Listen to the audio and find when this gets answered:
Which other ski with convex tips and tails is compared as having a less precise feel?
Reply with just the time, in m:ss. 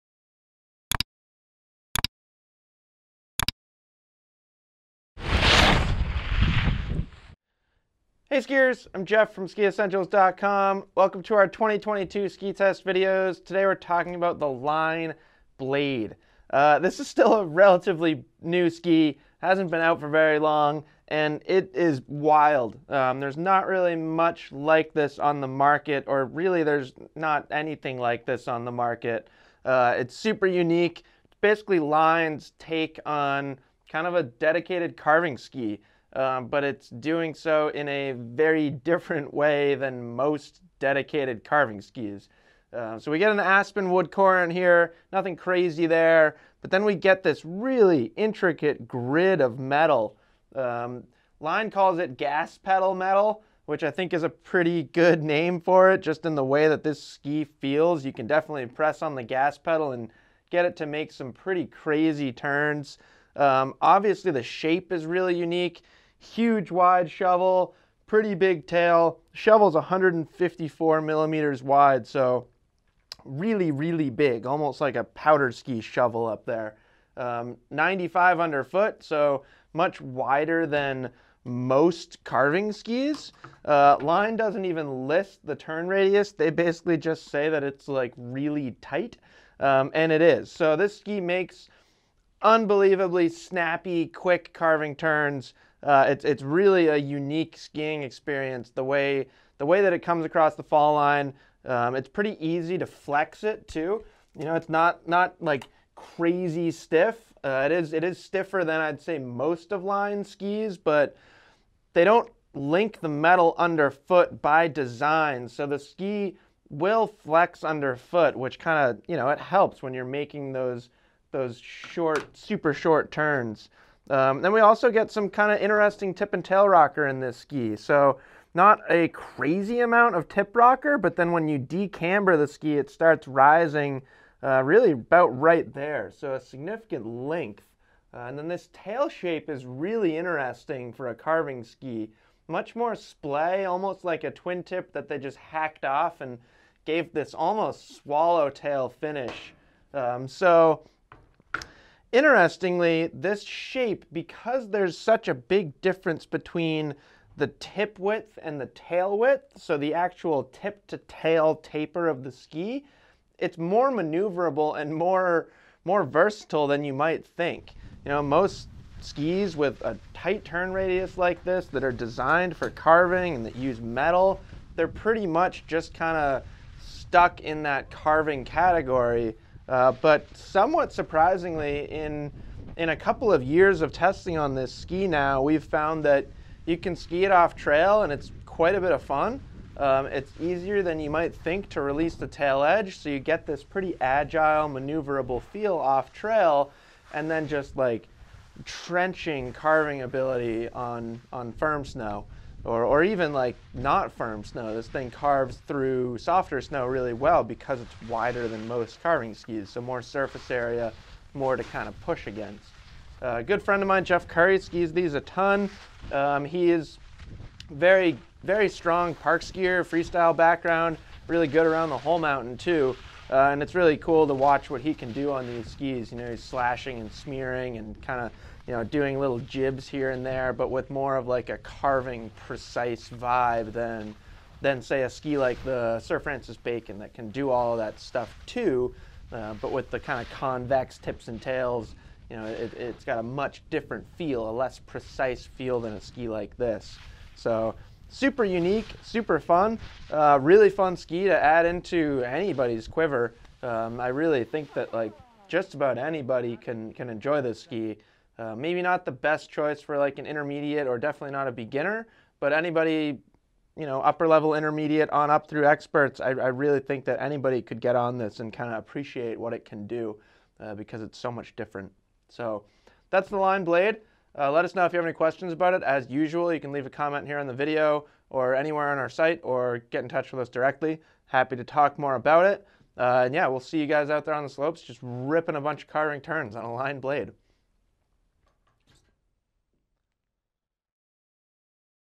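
3:55.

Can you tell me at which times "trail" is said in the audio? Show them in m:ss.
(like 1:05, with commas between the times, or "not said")
3:07, 3:16.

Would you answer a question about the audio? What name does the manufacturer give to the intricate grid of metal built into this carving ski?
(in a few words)
gas pedal metal.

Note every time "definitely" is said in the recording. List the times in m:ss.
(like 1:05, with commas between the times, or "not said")
0:58, 4:20.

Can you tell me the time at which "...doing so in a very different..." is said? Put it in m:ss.
0:36.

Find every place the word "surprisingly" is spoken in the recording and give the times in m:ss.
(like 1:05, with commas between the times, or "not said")
3:00.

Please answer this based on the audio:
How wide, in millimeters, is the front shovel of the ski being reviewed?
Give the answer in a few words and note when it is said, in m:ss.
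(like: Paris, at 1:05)
154, at 1:09.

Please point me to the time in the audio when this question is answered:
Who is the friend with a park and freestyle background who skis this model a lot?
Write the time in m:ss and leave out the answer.
3:34.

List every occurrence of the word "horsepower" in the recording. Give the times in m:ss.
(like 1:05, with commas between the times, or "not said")
not said.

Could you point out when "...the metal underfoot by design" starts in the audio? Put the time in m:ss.
1:52.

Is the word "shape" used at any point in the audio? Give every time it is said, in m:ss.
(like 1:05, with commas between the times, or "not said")
1:04, 2:19, 2:33.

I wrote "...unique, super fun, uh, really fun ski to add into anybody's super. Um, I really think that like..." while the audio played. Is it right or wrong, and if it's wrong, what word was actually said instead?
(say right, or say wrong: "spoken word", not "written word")
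wrong: "quiver", not "super".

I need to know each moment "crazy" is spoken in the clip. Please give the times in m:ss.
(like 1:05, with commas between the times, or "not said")
0:45, 1:01, 1:45, 2:09.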